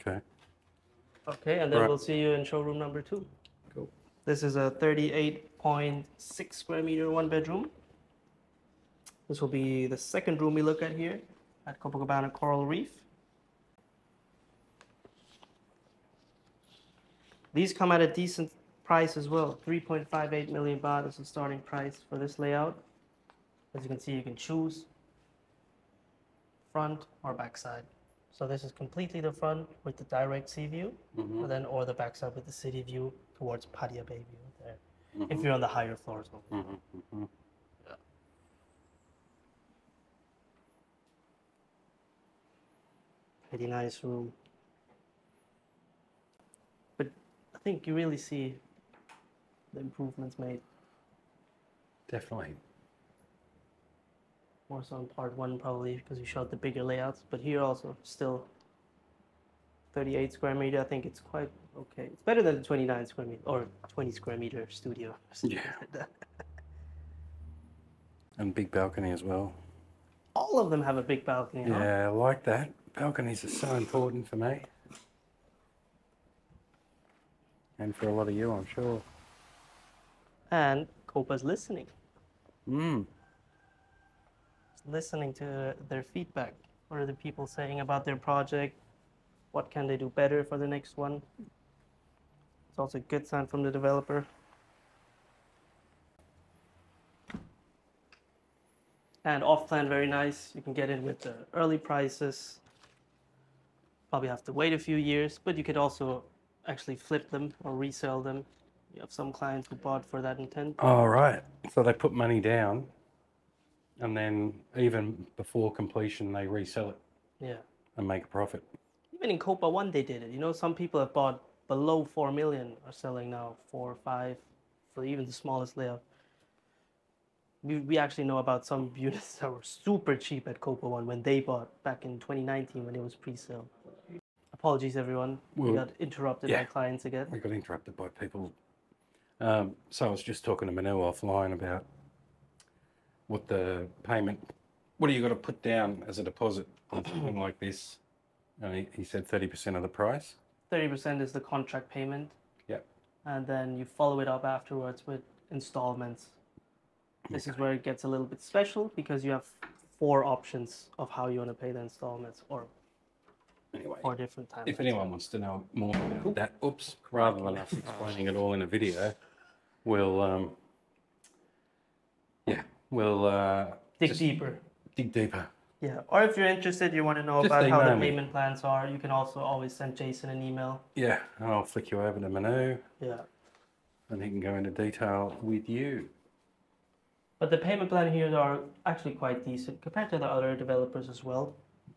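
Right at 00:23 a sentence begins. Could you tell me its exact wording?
As you can see, you can choose front or backside.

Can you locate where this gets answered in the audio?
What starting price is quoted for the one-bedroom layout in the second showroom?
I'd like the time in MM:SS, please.
00:19.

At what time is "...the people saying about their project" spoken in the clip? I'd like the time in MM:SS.
01:27.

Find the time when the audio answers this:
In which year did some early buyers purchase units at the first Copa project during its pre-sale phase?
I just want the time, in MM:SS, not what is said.
02:12.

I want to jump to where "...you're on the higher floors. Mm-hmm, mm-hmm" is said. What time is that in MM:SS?
00:35.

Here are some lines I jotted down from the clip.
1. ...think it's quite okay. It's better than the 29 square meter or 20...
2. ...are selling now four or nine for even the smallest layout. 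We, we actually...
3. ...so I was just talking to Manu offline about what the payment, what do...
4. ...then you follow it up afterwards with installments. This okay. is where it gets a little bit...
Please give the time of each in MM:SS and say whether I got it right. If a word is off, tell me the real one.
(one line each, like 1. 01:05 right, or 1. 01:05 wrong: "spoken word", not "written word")
1. 01:00 right
2. 02:02 wrong: "five", not "nine"
3. 02:19 right
4. 02:33 right.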